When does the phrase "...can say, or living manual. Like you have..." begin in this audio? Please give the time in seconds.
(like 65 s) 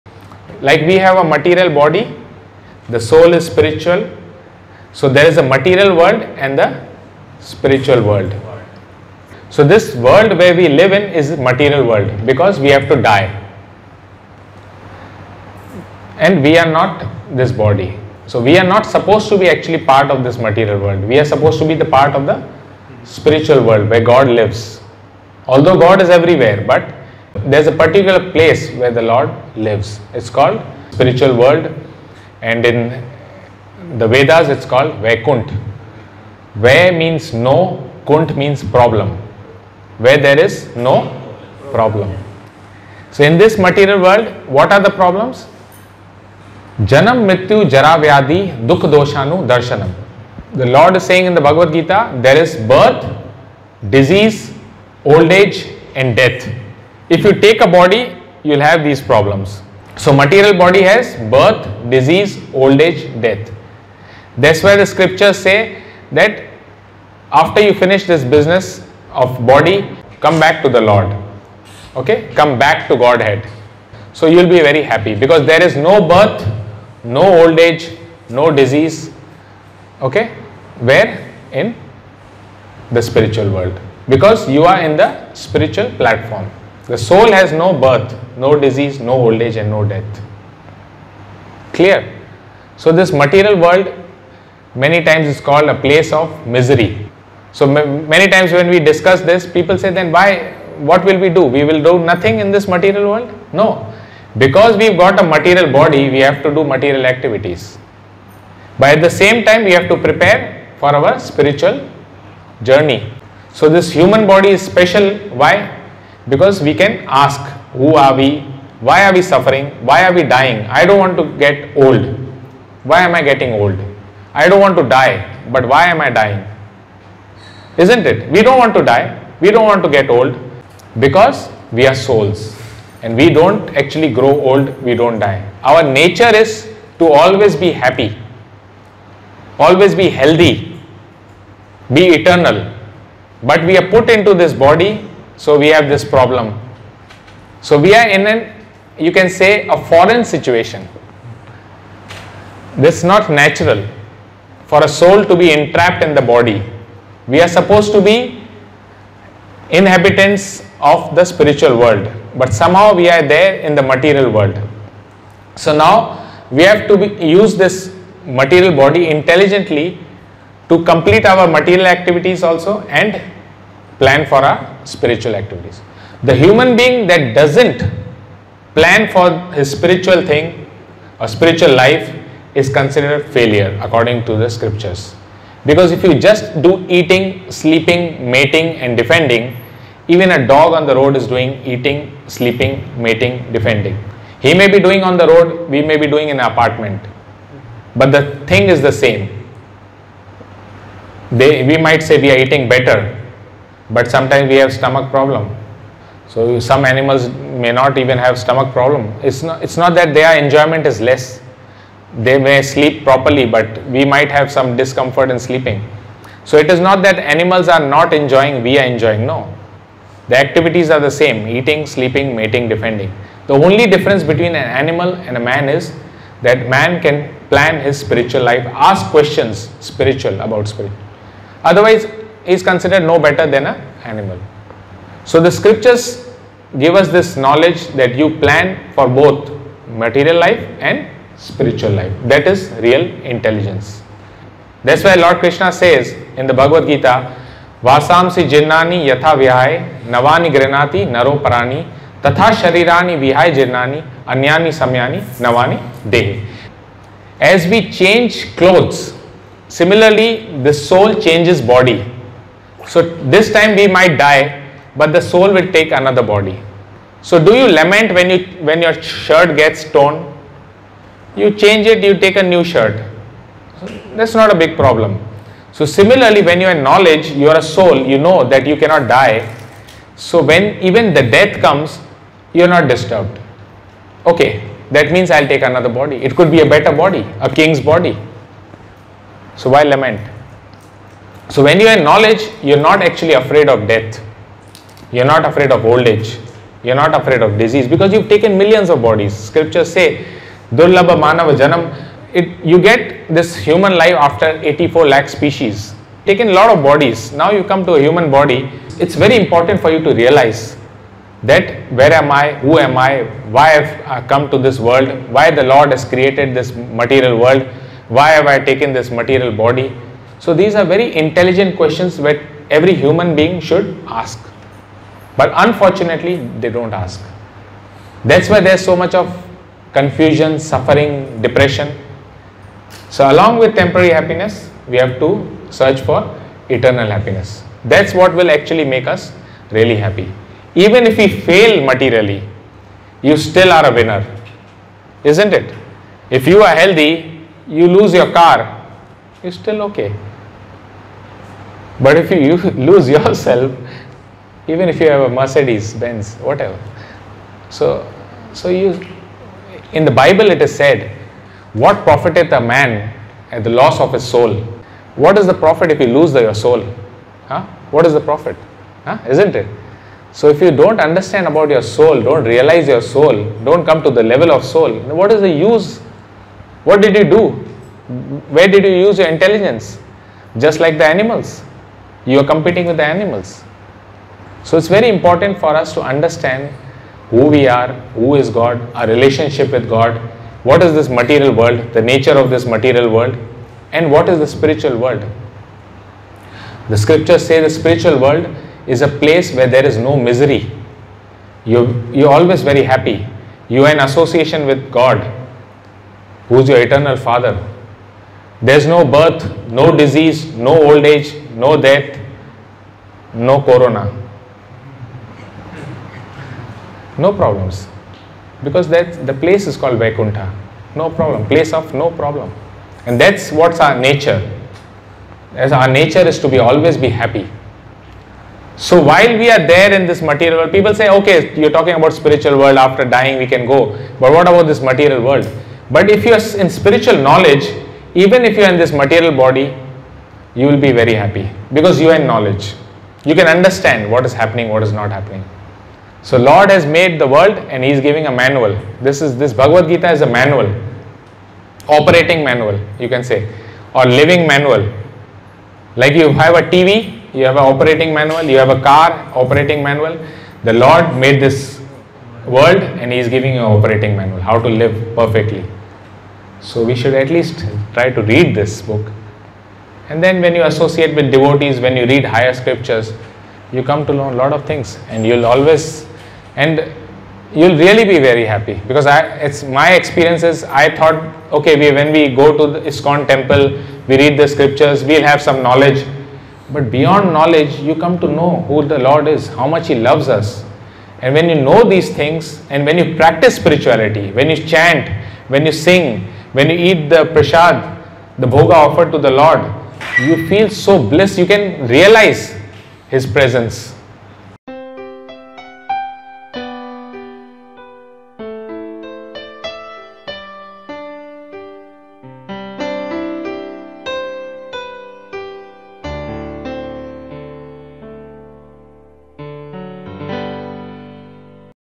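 453 s.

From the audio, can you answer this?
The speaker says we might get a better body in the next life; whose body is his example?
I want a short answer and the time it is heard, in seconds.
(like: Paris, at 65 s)
a king's body, at 287 s.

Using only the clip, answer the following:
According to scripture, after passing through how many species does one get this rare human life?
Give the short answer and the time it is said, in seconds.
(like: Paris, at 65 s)
84 lakh, at 304 s.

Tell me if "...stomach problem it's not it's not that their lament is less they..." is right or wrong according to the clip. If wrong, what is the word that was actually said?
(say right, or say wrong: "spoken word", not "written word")
wrong: "enjoyment", not "lament".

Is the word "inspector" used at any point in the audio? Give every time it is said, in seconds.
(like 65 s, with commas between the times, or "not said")
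not said.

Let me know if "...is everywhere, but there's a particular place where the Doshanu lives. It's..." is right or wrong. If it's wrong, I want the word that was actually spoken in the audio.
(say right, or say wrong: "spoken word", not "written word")
wrong: "Lord", not "Doshanu".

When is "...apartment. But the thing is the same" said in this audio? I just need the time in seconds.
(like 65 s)
196 s.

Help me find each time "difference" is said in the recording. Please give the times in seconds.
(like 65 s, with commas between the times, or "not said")
223 s.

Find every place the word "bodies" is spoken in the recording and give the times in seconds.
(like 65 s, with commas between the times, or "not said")
299 s, 306 s.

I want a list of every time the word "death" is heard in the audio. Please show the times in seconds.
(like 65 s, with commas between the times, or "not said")
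56 s, 63 s, 89 s, 281 s, 293 s, 411 s.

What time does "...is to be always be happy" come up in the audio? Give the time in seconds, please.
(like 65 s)
426 s.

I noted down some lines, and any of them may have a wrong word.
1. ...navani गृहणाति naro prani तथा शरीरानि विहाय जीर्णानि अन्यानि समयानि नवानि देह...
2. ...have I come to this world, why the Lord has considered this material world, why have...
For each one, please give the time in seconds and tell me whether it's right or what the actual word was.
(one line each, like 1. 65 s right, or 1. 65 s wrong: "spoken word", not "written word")
1. 250 s right
2. 313 s wrong: "created", not "considered".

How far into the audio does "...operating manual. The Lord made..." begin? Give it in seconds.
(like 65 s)
459 s.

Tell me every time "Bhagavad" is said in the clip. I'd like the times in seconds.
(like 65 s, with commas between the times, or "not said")
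51 s, 246 s, 449 s.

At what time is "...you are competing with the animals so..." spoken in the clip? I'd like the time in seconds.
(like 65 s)
382 s.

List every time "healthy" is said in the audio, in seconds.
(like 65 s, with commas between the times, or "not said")
140 s, 346 s.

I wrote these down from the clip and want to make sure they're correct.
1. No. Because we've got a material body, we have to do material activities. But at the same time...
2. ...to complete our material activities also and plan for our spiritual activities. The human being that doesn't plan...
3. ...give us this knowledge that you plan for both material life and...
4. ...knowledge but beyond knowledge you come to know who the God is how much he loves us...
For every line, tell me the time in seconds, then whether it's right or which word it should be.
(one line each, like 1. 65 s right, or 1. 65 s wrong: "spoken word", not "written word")
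1. 103 s right
2. 170 s right
3. 236 s right
4. 485 s wrong: "Lord", not "God".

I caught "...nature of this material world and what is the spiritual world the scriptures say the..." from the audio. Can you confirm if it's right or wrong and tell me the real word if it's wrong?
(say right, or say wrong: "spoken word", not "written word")
right.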